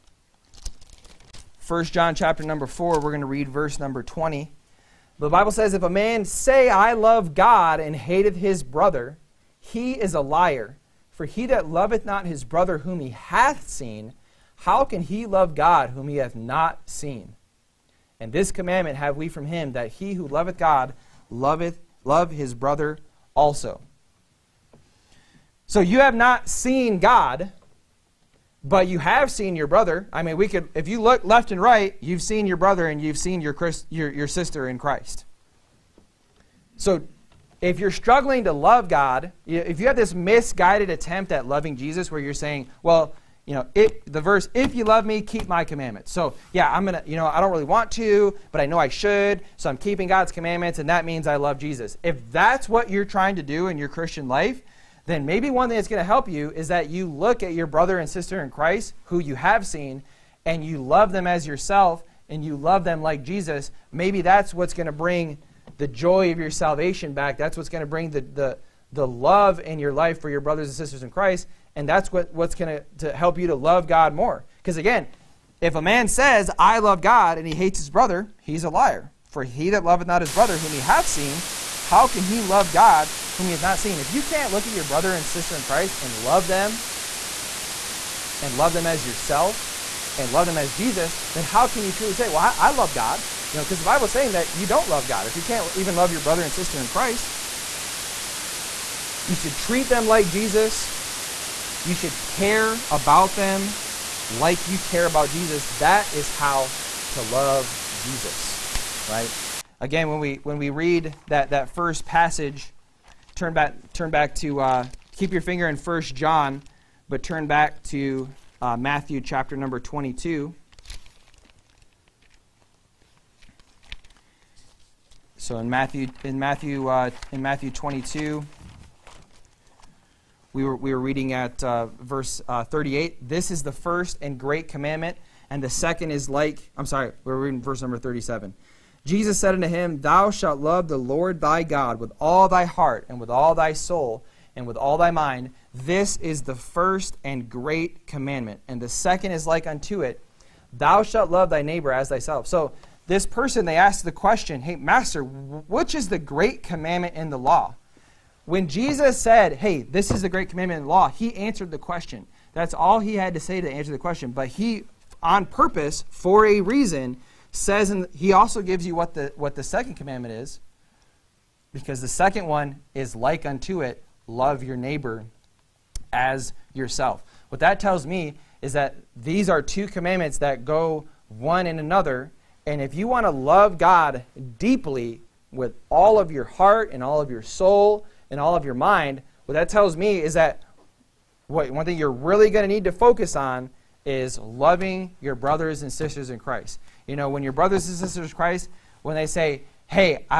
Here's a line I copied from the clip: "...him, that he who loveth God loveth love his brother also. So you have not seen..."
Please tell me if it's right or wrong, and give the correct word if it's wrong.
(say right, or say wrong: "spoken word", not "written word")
right.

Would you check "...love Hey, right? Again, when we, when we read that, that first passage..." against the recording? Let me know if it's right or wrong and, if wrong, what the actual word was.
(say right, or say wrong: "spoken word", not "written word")
wrong: "Jesus", not "Hey".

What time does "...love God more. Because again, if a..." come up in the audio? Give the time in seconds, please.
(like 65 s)
73 s.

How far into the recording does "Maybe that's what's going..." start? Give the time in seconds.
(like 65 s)
63 s.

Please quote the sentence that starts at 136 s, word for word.
I'm sorry, we we're reading verse number 37.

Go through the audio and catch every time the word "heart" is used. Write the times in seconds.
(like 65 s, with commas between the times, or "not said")
142 s, 186 s.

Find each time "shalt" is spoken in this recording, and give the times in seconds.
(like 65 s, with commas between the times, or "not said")
140 s, 151 s.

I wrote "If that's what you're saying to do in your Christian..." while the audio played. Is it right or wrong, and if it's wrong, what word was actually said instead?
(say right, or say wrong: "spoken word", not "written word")
wrong: "trying", not "saying".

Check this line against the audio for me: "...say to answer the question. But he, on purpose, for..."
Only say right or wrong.
right.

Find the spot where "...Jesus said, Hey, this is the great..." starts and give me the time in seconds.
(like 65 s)
158 s.